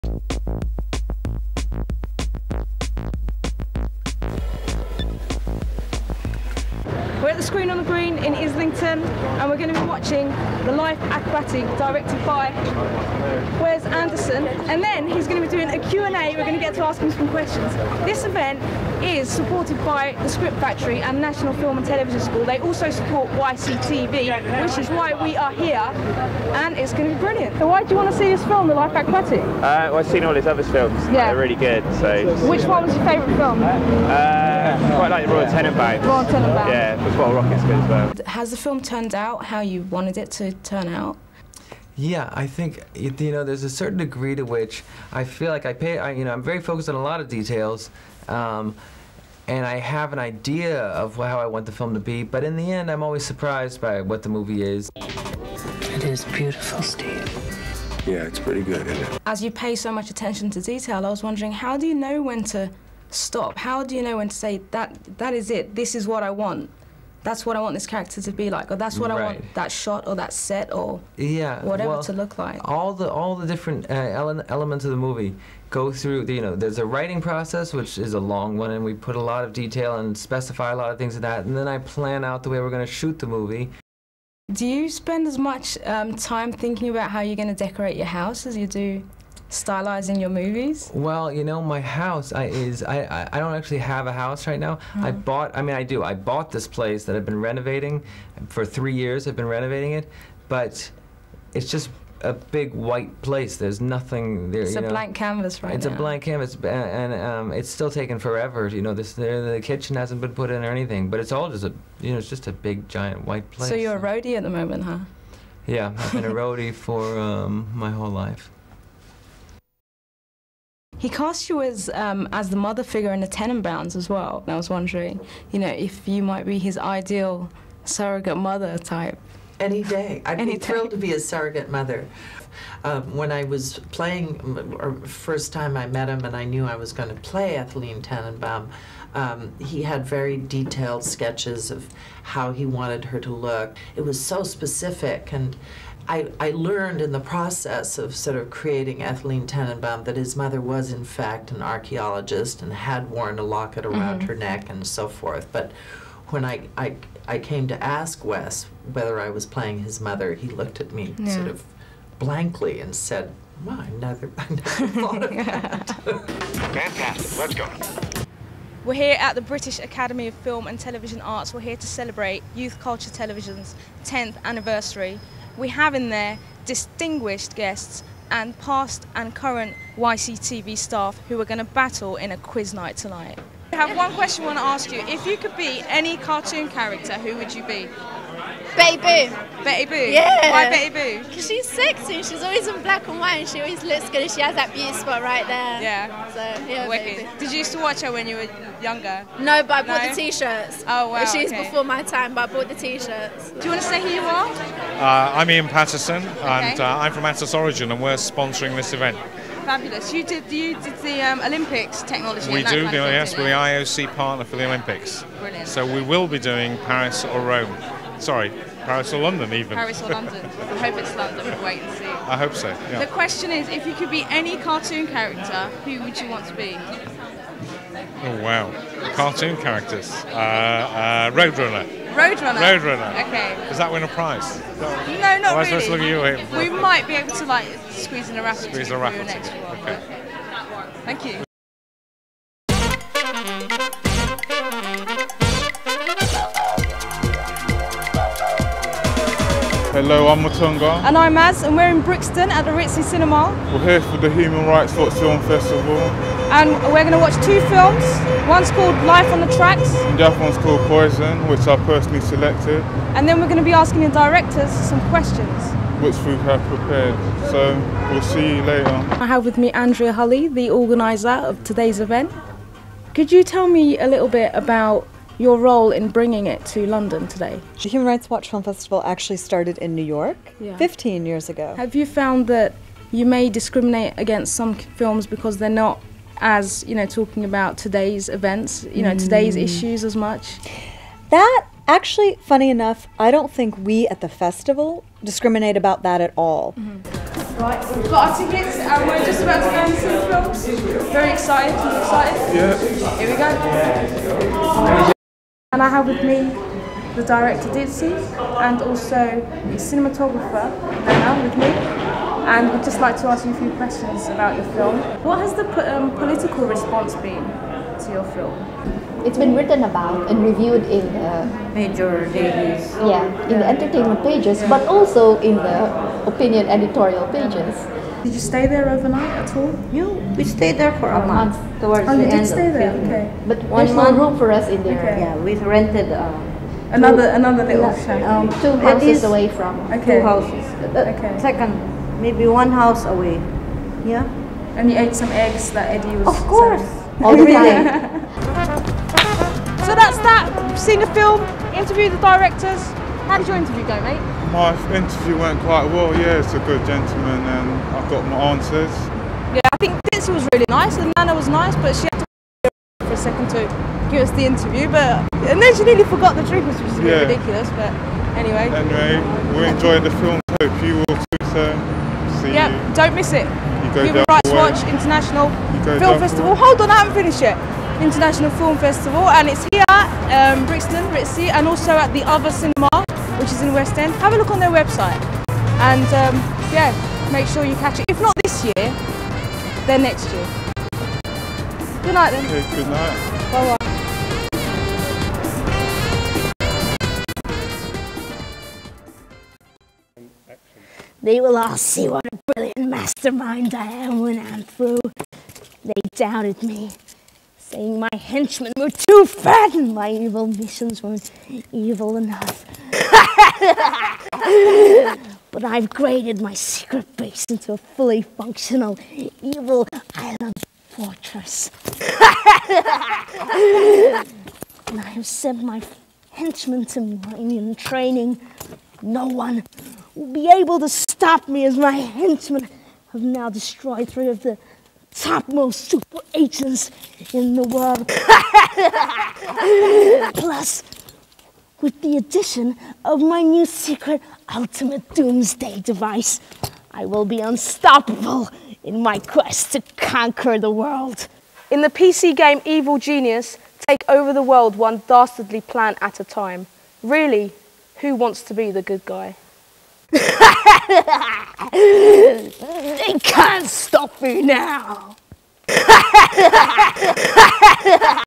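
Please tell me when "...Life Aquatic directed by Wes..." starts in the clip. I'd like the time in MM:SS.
00:10.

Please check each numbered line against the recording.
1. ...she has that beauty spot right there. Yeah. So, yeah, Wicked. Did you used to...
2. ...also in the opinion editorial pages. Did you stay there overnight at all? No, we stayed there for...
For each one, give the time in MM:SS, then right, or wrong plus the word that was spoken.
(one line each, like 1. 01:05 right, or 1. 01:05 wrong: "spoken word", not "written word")
1. 03:14 right
2. 05:24 right.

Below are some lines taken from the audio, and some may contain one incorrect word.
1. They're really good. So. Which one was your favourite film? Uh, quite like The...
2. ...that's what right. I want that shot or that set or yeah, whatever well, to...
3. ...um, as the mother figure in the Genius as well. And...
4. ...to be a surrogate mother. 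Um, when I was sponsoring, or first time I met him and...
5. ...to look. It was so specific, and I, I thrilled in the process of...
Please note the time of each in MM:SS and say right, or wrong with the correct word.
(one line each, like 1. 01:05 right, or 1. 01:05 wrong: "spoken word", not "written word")
1. 00:31 right
2. 01:08 right
3. 02:01 wrong: "Tenenbaums", not "Genius"
4. 02:10 wrong: "playing", not "sponsoring"
5. 02:23 wrong: "learned", not "thrilled".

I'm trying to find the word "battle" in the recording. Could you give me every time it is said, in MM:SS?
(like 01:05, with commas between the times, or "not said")
03:01.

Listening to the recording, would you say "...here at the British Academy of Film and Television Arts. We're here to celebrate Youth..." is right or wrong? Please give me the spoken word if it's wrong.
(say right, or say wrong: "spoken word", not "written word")
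right.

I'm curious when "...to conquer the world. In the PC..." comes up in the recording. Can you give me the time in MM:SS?
07:29.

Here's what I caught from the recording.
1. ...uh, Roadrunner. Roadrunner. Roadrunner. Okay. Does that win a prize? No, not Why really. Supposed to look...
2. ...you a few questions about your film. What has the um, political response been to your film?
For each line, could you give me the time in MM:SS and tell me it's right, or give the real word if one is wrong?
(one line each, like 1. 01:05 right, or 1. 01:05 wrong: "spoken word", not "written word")
1. 03:50 right
2. 05:13 right.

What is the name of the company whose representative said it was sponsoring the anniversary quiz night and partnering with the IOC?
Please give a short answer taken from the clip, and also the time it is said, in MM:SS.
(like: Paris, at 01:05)
Atos Origin, at 03:27.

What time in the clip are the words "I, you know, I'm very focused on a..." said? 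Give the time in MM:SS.
00:45.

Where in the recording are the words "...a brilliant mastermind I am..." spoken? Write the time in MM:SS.
06:42.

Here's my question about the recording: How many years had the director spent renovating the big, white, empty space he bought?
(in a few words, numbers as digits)
3.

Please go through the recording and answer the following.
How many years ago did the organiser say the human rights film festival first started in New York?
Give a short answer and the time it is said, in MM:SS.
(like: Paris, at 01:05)
15, at 04:40.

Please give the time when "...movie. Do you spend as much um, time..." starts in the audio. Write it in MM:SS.
01:23.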